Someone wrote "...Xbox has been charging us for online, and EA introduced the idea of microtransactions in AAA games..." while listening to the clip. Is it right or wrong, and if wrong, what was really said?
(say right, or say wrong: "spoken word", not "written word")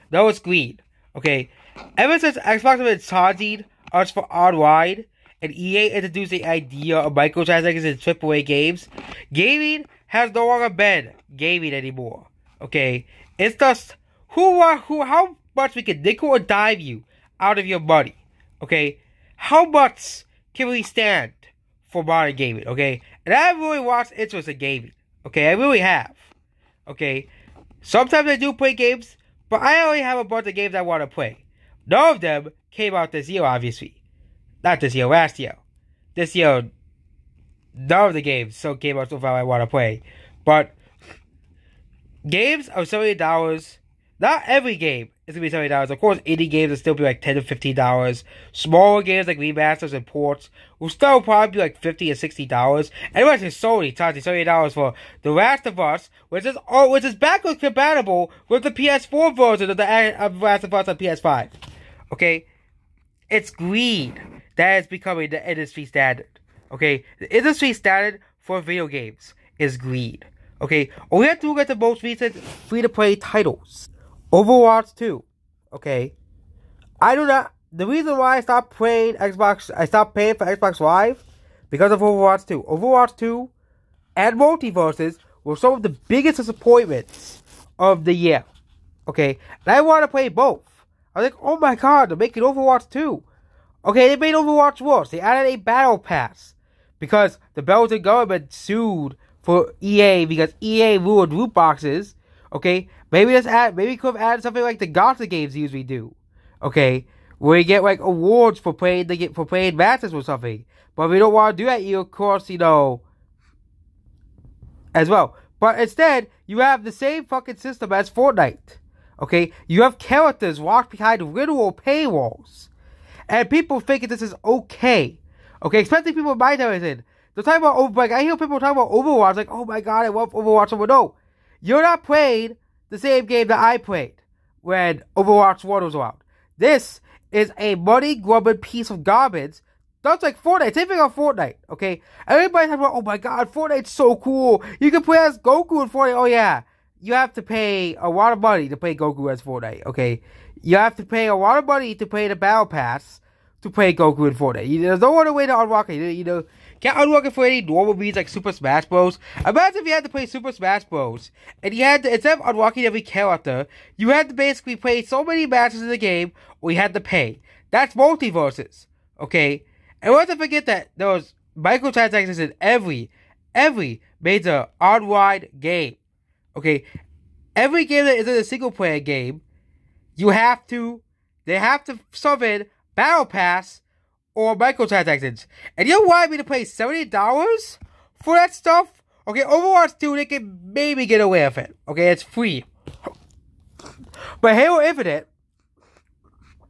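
right.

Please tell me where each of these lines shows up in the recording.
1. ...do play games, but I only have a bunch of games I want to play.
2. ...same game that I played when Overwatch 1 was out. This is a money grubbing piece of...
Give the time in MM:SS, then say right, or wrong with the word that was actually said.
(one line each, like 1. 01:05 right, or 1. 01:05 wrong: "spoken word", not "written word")
1. 00:28 right
2. 02:12 right.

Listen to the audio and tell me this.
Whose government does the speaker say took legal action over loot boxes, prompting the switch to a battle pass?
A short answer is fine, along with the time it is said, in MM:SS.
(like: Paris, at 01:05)
Belgian, at 01:37.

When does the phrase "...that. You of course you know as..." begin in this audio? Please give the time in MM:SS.
01:51.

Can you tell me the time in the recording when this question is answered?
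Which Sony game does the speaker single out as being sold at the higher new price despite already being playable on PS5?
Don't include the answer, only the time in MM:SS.
00:55.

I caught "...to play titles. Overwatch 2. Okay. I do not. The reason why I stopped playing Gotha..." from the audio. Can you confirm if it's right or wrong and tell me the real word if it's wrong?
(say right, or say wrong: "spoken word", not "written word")
wrong: "Xbox", not "Gotha".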